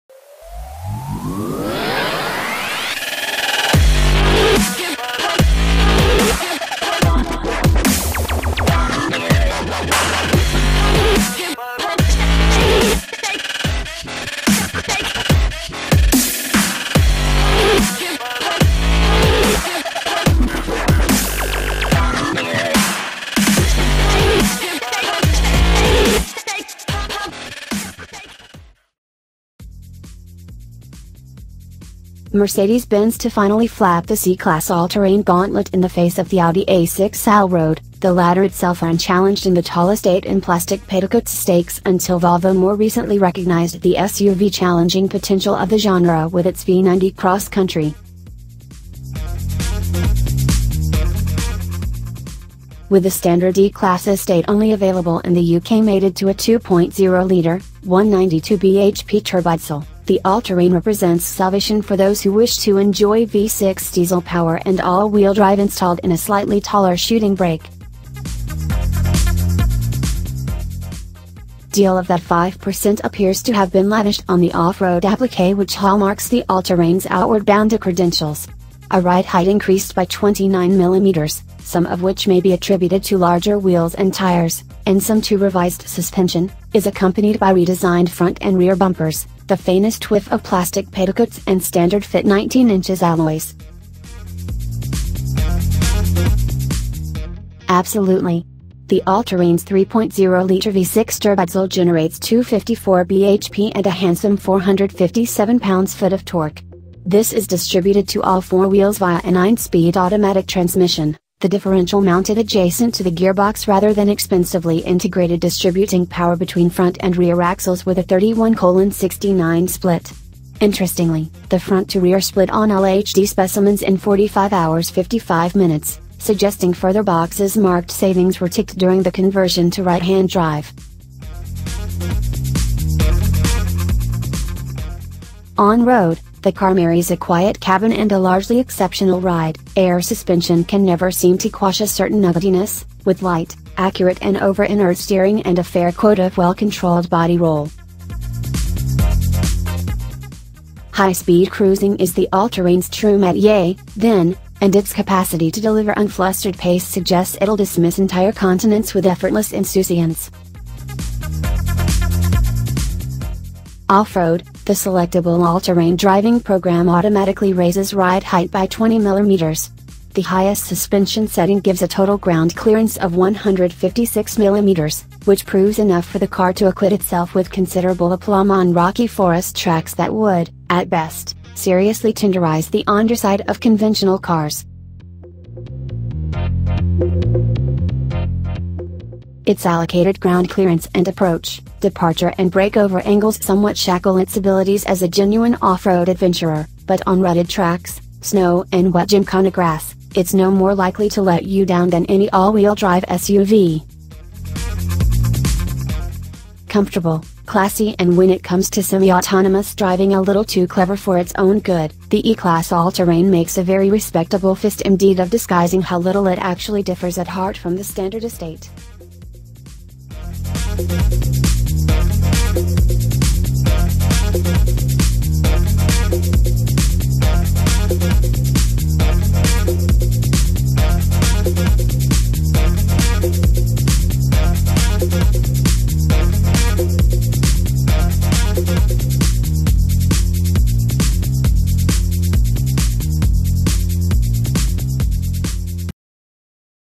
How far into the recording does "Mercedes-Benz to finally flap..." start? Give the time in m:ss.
0:32.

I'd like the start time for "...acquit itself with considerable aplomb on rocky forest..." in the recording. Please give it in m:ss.
2:56.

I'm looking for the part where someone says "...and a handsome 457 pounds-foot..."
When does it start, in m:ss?
1:43.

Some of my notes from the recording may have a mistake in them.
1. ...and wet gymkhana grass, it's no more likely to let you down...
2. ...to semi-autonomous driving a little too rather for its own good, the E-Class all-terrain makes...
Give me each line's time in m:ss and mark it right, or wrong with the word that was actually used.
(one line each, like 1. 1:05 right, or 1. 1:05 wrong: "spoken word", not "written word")
1. 3:18 right
2. 3:28 wrong: "clever", not "rather".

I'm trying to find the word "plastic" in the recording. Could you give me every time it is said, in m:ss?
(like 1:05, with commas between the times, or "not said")
0:40, 1:30.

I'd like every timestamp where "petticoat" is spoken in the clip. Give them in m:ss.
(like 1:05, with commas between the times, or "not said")
0:40, 1:30.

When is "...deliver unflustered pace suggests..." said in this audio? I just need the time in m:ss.
2:35.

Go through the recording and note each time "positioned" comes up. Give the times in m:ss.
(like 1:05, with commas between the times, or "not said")
not said.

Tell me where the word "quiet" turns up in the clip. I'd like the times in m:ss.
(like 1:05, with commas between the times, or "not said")
2:17.